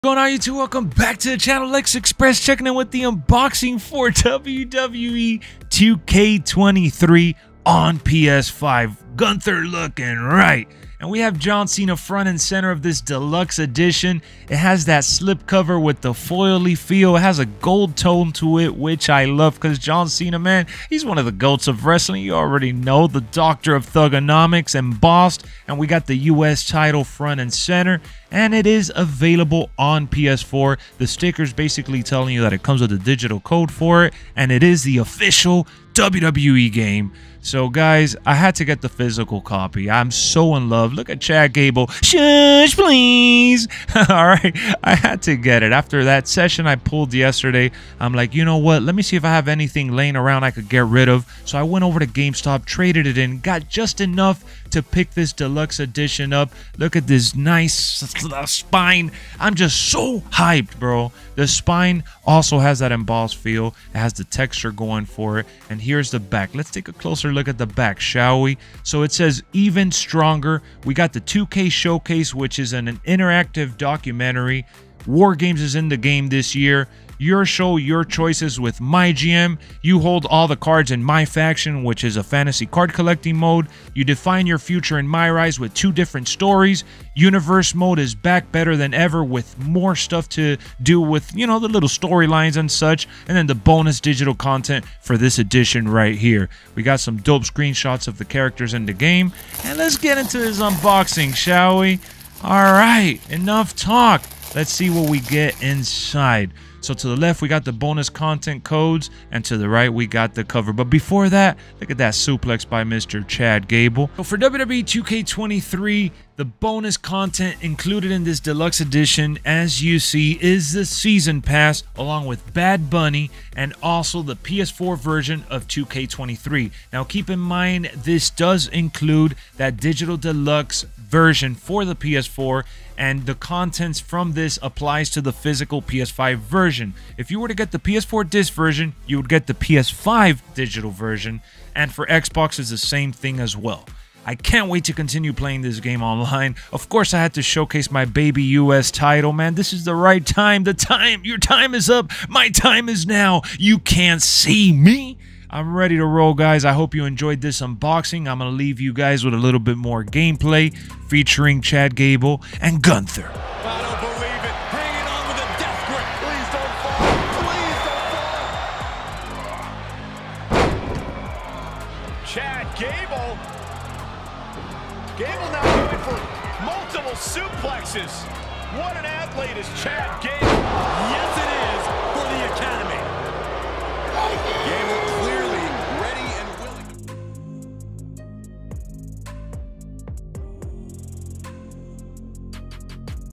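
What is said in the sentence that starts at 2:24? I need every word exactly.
I can't wait to continue playing this game online.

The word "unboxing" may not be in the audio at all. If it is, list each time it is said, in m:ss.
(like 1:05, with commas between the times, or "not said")
0:03, 1:40, 2:37.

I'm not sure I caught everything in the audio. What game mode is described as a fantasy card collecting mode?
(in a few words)
MyFaction.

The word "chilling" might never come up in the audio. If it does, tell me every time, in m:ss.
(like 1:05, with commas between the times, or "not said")
not said.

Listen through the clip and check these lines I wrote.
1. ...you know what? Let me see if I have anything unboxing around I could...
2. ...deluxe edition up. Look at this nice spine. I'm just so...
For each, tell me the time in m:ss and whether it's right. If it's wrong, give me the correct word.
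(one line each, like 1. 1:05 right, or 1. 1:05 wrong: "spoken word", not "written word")
1. 0:48 wrong: "laying", not "unboxing"
2. 0:55 right.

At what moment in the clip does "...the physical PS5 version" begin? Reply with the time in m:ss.
2:15.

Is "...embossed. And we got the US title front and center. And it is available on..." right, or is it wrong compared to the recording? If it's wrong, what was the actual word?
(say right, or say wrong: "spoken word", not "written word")
right.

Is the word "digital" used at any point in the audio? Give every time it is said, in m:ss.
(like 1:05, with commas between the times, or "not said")
0:32, 1:34, 2:09, 2:20.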